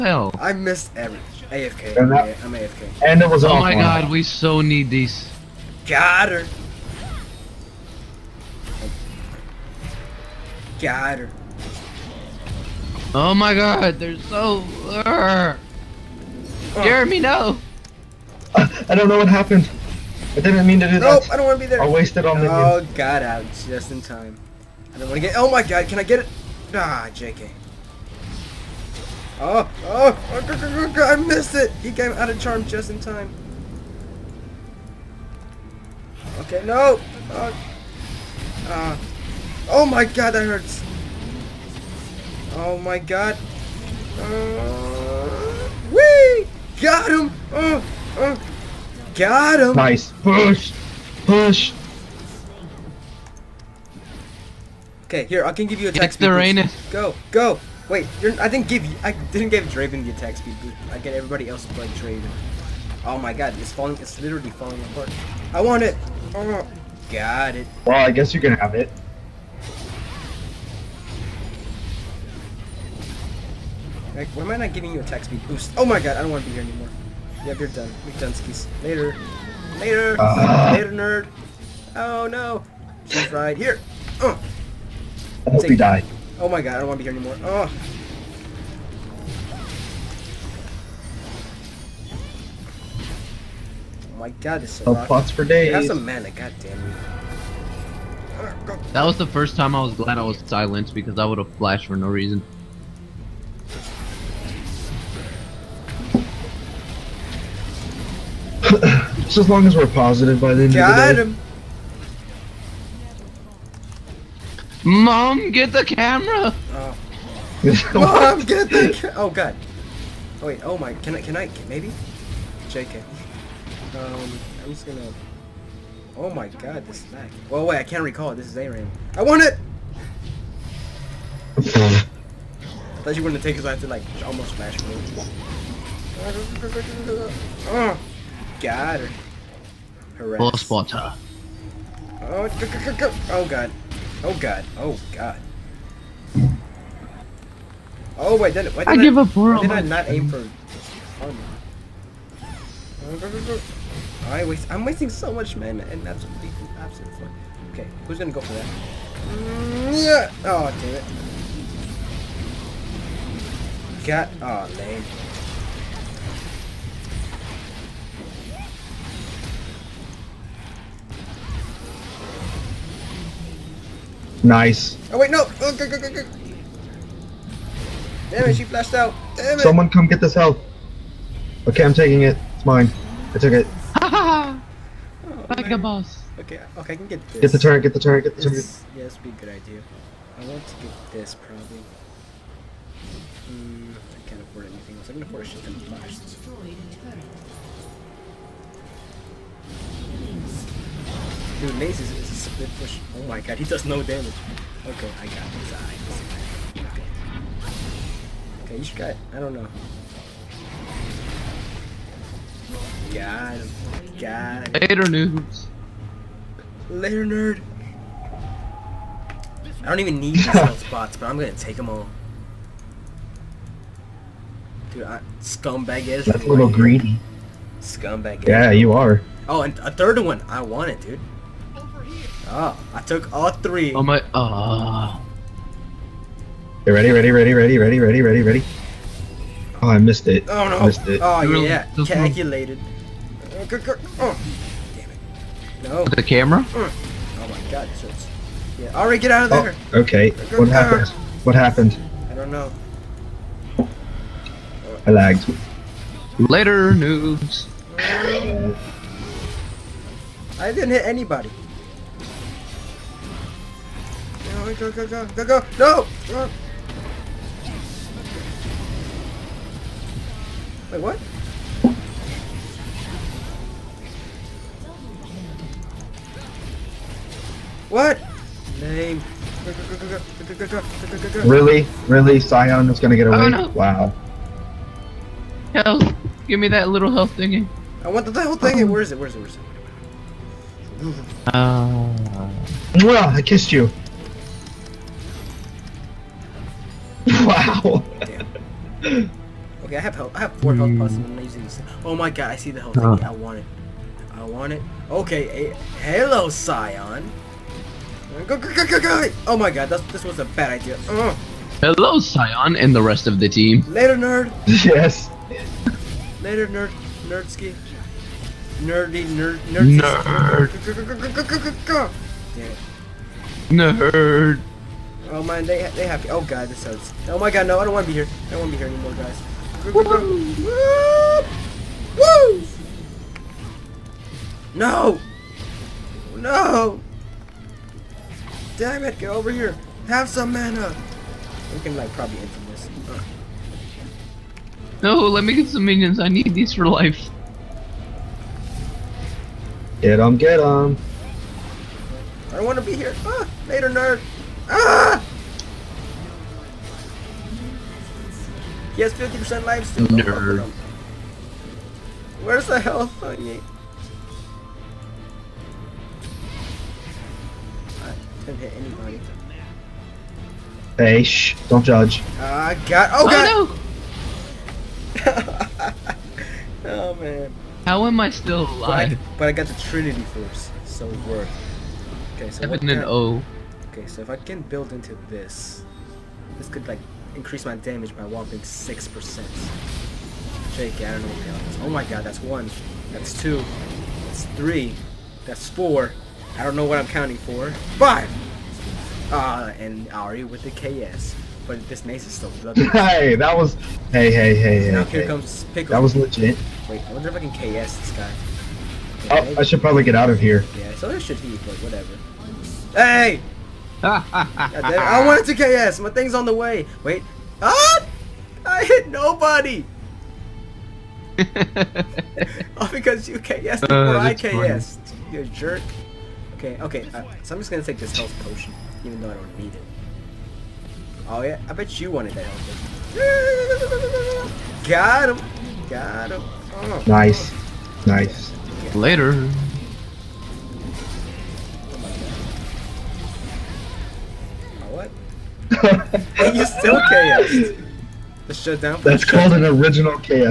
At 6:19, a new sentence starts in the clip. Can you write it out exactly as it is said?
But I, but I got the Trinity Force, so it worked.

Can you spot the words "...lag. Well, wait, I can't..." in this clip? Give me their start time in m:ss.
2:07.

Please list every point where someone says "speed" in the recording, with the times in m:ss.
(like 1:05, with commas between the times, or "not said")
0:56, 1:00, 1:15.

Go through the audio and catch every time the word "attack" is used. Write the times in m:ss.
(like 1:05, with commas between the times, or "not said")
0:55, 1:00, 1:14.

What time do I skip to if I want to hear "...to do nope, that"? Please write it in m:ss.
0:20.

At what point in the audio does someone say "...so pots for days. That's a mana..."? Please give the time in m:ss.
1:34.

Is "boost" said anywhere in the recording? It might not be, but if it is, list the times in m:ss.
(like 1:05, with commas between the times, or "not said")
1:00, 1:15.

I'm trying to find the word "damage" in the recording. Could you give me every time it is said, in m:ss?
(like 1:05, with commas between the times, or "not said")
3:24, 6:27.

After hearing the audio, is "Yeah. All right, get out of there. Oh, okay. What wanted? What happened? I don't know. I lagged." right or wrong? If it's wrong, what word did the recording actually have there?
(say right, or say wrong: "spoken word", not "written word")
wrong: "happened", not "wanted".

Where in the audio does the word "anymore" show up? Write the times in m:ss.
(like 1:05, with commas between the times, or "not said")
1:16, 1:27, 5:28.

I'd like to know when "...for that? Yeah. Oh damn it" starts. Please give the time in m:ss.
2:38.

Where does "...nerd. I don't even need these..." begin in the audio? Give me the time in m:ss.
3:37.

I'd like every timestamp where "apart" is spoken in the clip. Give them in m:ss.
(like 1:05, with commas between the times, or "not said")
1:04.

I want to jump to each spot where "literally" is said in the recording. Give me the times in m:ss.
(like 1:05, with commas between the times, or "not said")
1:04.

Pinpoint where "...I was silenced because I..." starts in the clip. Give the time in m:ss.
1:40.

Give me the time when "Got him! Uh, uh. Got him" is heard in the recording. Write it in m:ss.
0:46.